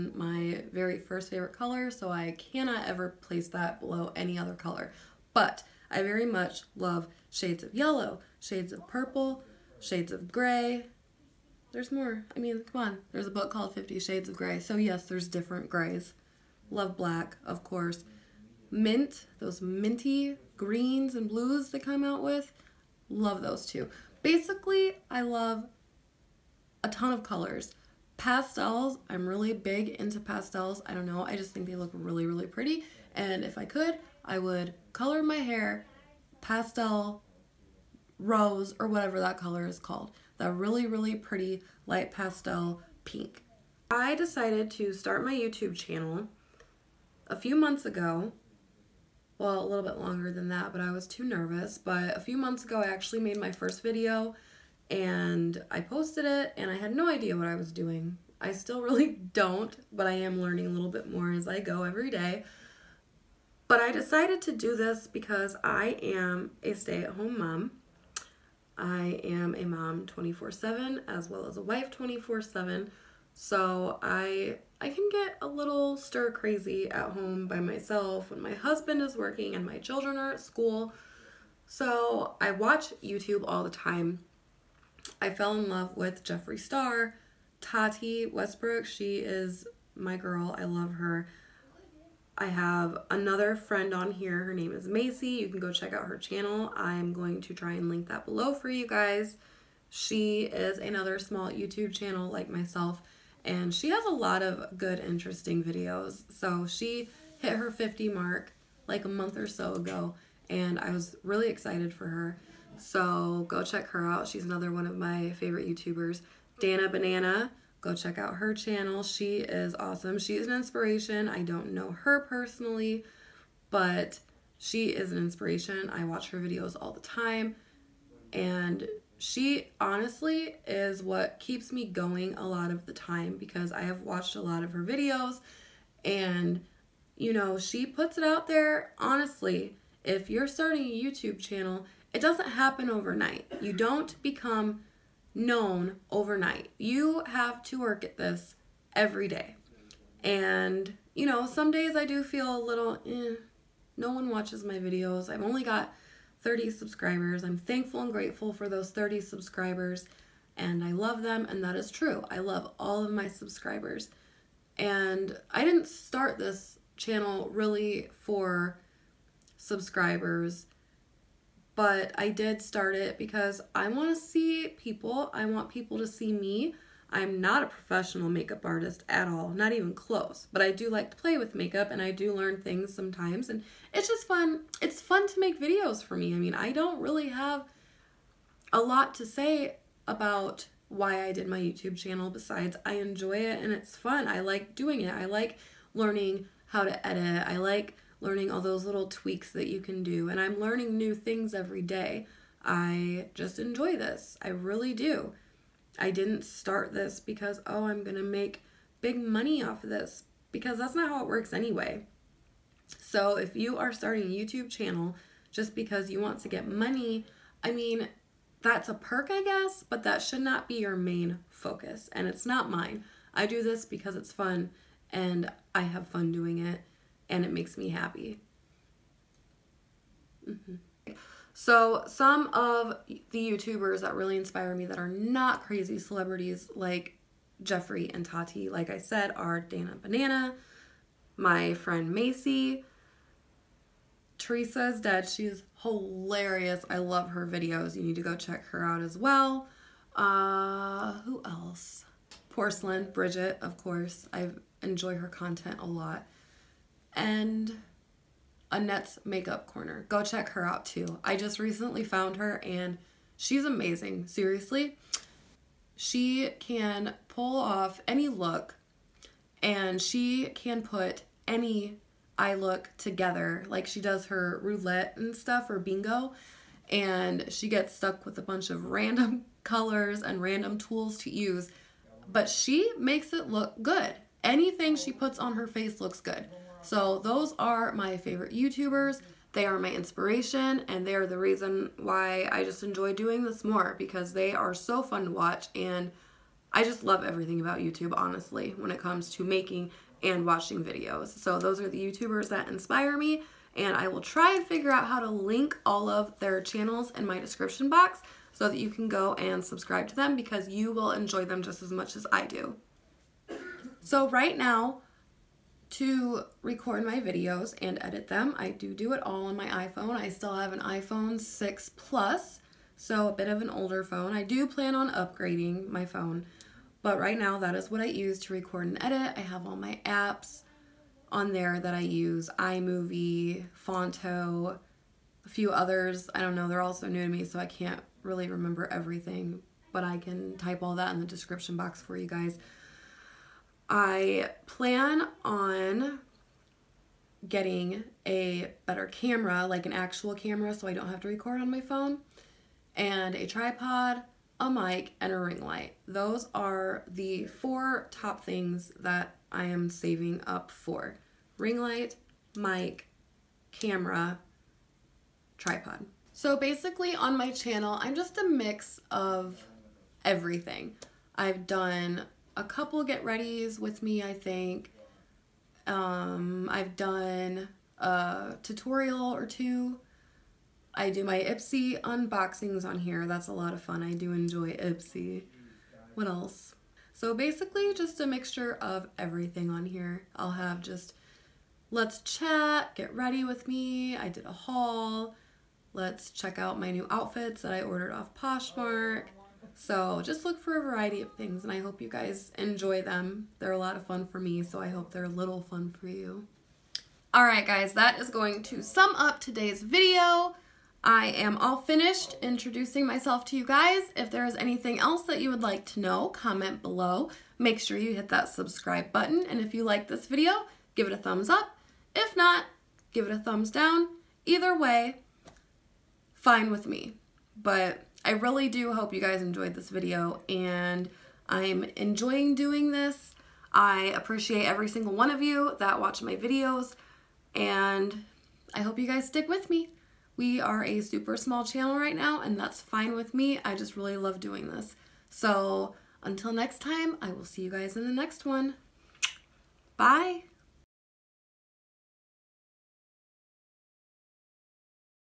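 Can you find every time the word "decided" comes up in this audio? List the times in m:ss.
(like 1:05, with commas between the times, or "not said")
0:44, 1:03.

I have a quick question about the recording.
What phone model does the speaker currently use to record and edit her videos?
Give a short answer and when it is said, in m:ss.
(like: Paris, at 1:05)
iPhone 6 Plus, at 5:20.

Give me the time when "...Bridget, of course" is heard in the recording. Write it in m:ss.
4:13.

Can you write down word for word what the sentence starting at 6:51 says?
I am all finished introducing myself to you guys.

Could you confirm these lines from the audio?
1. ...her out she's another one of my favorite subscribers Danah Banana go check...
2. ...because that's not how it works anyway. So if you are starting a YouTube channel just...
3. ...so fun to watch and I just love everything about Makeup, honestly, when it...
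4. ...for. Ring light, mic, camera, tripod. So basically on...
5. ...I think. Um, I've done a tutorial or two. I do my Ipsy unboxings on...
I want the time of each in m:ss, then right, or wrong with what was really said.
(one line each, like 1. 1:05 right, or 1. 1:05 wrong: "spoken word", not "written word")
1. 1:53 wrong: "youtubers", not "subscribers"
2. 3:30 right
3. 4:54 wrong: "YouTube", not "Makeup"
4. 6:00 right
5. 6:14 right.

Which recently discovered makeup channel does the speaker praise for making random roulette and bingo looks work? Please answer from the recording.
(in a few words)
Annette's Makeup Corner.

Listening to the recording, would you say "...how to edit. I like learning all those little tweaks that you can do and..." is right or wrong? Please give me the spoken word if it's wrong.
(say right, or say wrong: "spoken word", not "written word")
right.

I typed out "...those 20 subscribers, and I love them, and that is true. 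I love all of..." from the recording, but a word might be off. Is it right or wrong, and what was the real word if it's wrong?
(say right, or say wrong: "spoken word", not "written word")
wrong: "30", not "20".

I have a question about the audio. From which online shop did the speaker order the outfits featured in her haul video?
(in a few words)
Poshmark.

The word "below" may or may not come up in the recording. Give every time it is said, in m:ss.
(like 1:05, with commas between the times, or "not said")
0:03, 1:38, 6:56.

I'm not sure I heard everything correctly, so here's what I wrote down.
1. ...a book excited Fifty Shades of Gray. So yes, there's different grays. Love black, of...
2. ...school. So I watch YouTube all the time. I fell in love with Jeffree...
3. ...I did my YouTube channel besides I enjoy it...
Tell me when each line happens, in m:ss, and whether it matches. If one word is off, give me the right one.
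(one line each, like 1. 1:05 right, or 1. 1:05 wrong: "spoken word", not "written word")
1. 0:13 wrong: "called", not "excited"
2. 1:20 right
3. 3:11 right.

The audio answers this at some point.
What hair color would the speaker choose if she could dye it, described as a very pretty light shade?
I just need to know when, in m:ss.
0:36.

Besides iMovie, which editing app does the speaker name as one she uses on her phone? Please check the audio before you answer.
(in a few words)
Phonto.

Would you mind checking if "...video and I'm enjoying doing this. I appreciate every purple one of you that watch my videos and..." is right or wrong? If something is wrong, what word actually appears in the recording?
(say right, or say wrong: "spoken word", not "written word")
wrong: "single", not "purple".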